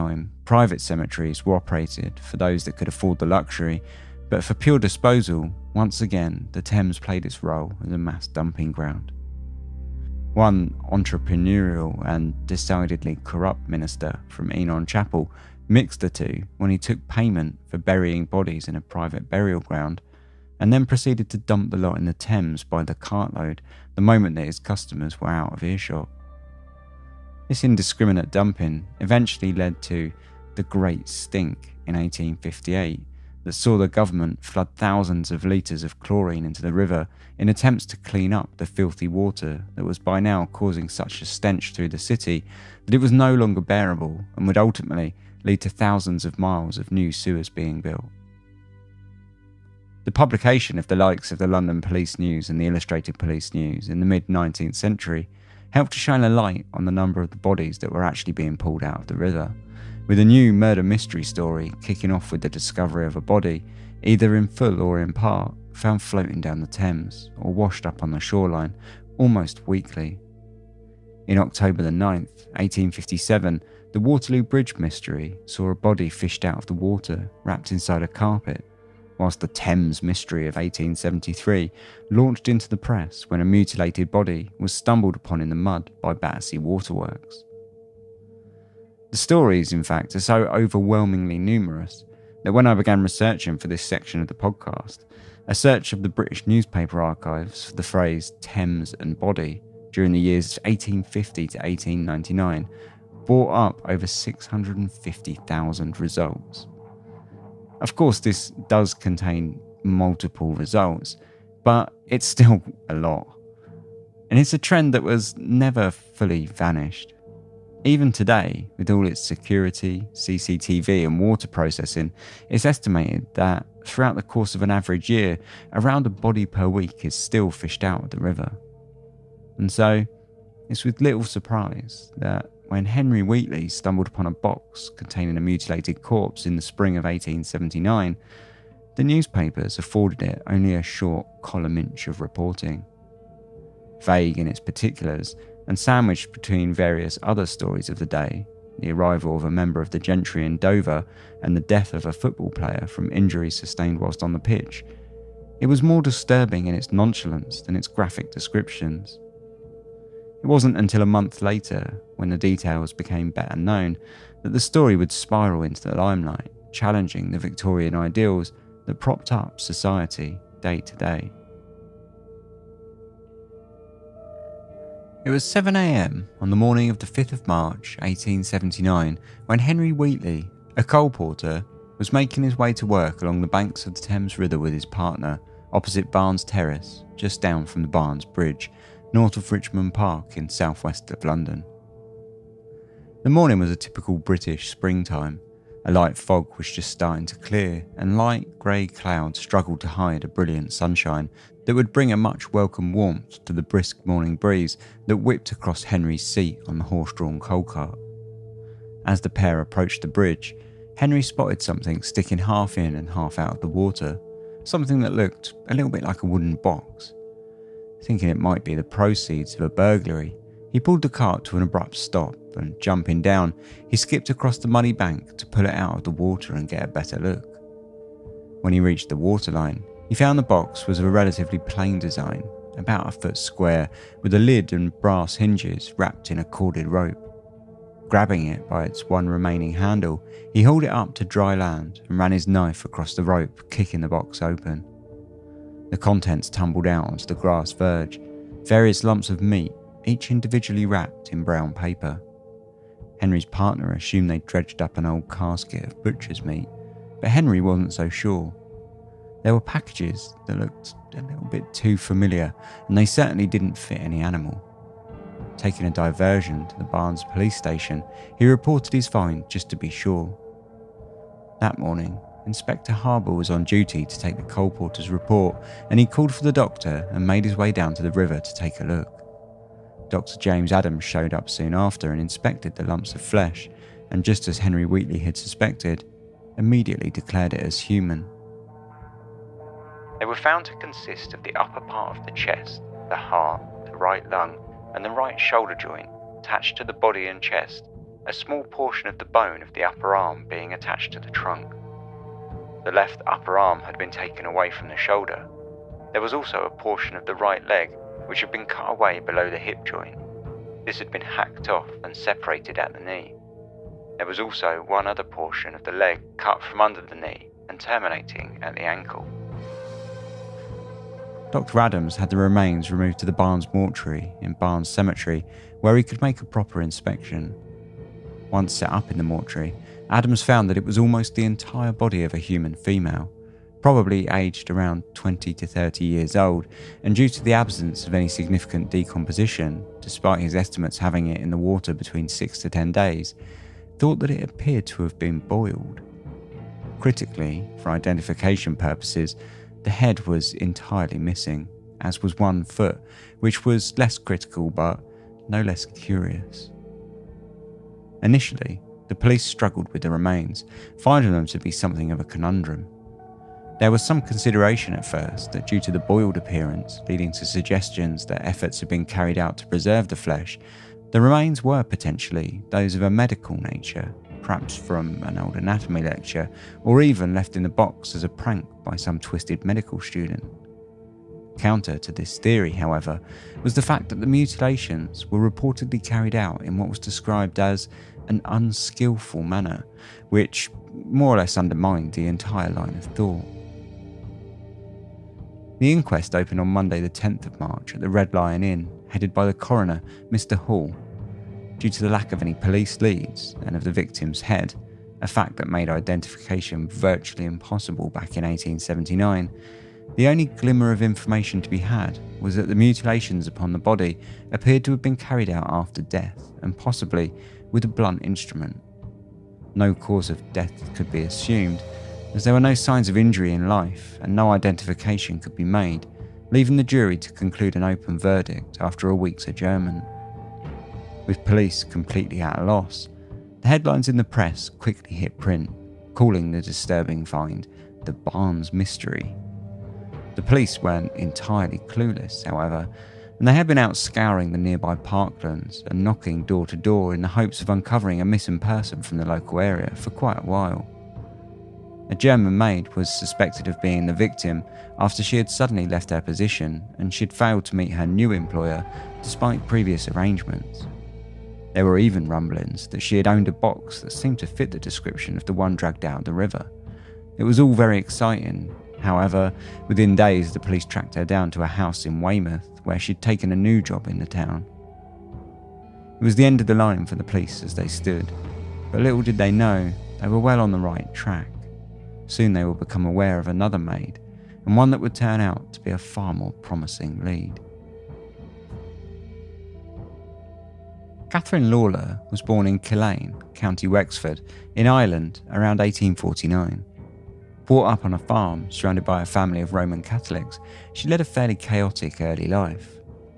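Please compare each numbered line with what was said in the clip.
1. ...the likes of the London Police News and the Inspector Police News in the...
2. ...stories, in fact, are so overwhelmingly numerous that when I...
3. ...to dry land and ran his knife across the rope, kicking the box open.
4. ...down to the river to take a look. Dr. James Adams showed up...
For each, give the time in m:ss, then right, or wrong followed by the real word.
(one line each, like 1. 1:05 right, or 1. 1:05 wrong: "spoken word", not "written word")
1. 0:50 wrong: "Illustrated", not "Inspector"
2. 1:29 right
3. 4:01 right
4. 4:37 right.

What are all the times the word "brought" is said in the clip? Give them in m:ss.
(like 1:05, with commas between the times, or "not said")
1:43, 8:17.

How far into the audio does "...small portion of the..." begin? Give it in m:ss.
4:58.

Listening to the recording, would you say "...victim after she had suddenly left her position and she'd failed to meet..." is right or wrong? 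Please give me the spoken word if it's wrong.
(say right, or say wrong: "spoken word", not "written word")
right.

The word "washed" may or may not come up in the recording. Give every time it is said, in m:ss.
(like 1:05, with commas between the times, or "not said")
1:07.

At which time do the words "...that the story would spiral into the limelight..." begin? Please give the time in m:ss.
2:44.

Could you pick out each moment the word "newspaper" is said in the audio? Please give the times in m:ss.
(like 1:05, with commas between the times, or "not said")
1:36, 2:19.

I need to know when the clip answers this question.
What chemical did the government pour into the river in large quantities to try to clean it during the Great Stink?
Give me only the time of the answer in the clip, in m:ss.
0:35.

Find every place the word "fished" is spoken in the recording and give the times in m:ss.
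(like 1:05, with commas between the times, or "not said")
1:16, 2:07.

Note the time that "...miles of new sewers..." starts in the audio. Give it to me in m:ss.
0:46.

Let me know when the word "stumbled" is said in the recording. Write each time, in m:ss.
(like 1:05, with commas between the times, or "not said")
1:24, 2:13.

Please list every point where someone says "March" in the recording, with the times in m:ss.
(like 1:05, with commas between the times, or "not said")
2:57, 6:37.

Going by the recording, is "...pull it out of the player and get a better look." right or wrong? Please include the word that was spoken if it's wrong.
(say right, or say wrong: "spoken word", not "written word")
wrong: "water", not "player".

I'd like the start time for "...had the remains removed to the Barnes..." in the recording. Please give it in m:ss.
5:22.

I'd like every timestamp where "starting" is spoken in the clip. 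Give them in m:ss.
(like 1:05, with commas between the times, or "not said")
3:16.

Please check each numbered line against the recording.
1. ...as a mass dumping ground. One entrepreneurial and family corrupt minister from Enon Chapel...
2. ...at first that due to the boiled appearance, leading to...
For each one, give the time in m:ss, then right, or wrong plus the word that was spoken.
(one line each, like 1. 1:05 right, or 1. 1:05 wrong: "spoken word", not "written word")
1. 0:07 wrong: "decidedly", not "family"
2. 6:04 right.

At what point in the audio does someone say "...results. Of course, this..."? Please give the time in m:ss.
1:46.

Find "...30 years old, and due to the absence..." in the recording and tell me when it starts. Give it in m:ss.
5:35.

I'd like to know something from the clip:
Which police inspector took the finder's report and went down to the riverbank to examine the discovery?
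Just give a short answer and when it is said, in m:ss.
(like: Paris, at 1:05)
Inspector Harbour, at 4:32.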